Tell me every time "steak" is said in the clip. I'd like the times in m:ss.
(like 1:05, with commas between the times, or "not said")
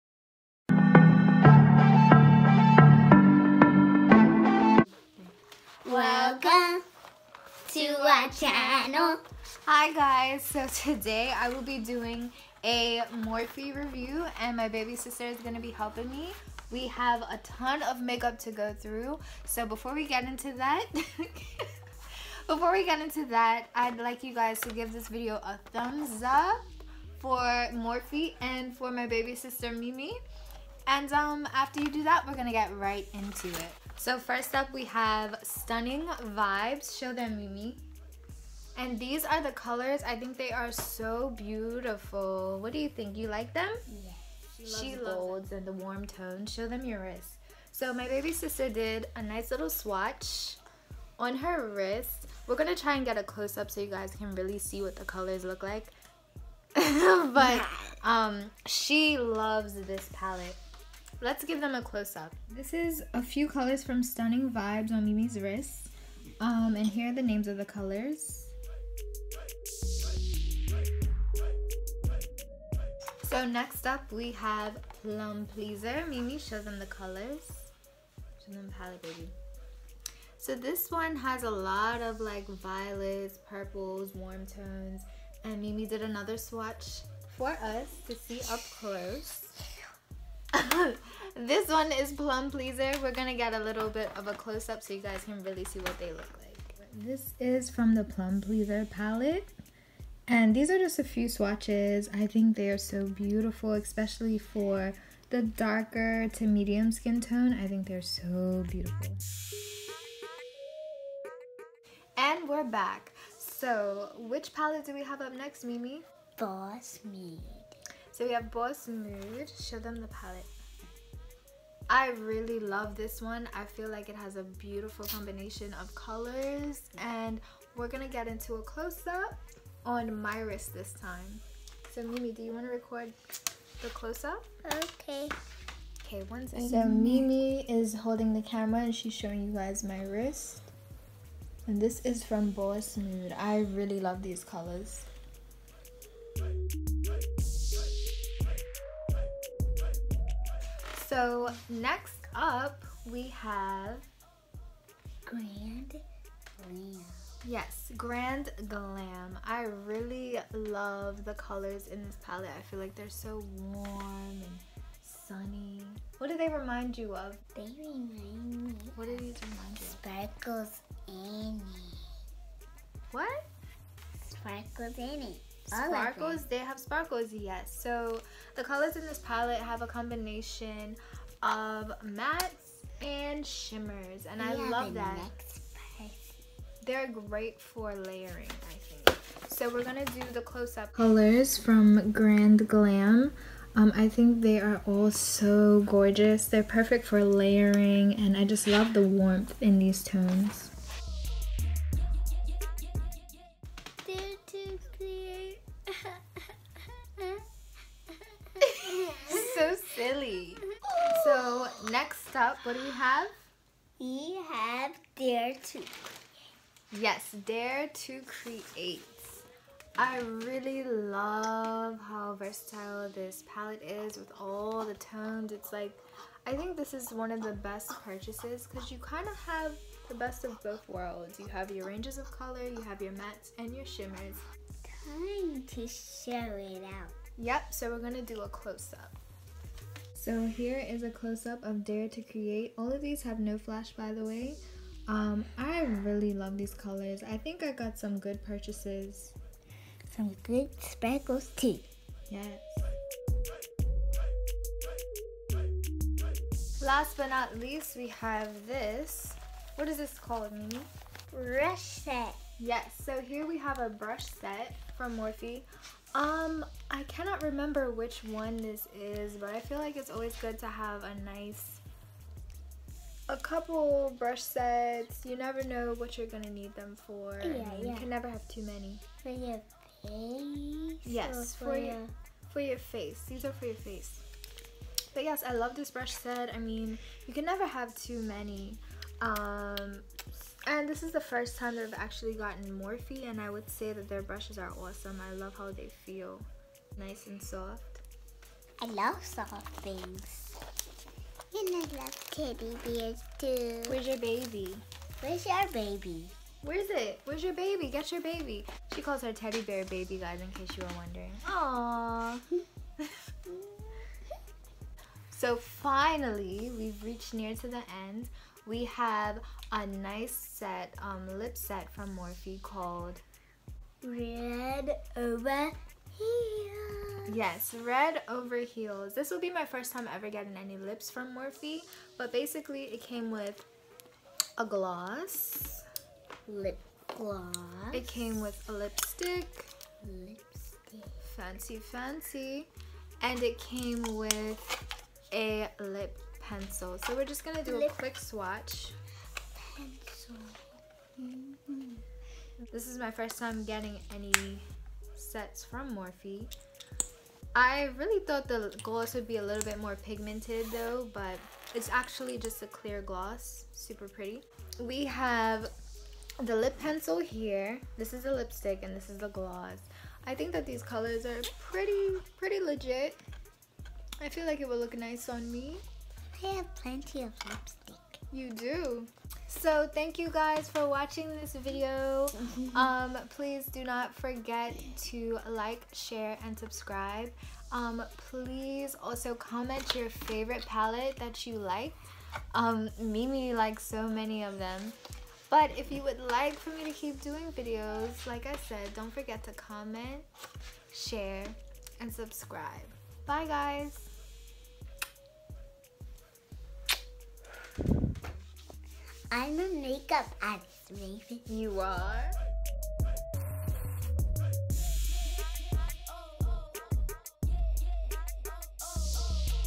not said.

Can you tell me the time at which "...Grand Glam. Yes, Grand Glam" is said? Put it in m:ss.
2:35.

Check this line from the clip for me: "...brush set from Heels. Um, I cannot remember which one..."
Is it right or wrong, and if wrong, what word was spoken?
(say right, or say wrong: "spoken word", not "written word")
wrong: "Morphe", not "Heels".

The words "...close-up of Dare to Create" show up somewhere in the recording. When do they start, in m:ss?
4:01.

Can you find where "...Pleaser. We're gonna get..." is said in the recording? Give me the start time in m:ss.
1:32.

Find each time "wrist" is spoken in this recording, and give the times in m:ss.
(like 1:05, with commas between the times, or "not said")
0:47, 0:51, 1:05, 2:10, 2:20.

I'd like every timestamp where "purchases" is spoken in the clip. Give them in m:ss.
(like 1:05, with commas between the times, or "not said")
3:48, 4:08.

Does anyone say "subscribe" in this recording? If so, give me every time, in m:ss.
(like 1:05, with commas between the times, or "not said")
6:26, 6:42.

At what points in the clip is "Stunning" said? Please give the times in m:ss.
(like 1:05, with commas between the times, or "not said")
0:35, 1:04.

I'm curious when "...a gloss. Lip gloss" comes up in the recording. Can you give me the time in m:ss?
5:34.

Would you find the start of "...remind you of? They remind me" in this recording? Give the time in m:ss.
2:46.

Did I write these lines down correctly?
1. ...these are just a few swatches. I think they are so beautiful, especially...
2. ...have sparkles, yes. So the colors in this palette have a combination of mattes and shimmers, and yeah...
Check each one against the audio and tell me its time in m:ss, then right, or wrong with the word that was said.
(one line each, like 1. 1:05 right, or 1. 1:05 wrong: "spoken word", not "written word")
1. 1:40 right
2. 2:56 right.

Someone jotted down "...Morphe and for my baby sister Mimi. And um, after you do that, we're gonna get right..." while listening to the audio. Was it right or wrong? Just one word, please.
right.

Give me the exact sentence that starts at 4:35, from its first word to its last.
You never know what you're gonna need them for.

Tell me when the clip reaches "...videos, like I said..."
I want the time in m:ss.
6:37.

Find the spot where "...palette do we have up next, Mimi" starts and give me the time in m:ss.
1:54.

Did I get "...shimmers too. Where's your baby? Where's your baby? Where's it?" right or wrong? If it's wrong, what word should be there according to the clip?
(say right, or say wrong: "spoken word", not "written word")
wrong: "bears", not "shimmers".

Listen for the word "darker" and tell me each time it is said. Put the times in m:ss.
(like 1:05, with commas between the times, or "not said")
1:45.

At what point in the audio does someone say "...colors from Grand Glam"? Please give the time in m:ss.
3:10.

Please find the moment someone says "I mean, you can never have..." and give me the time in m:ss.
4:46.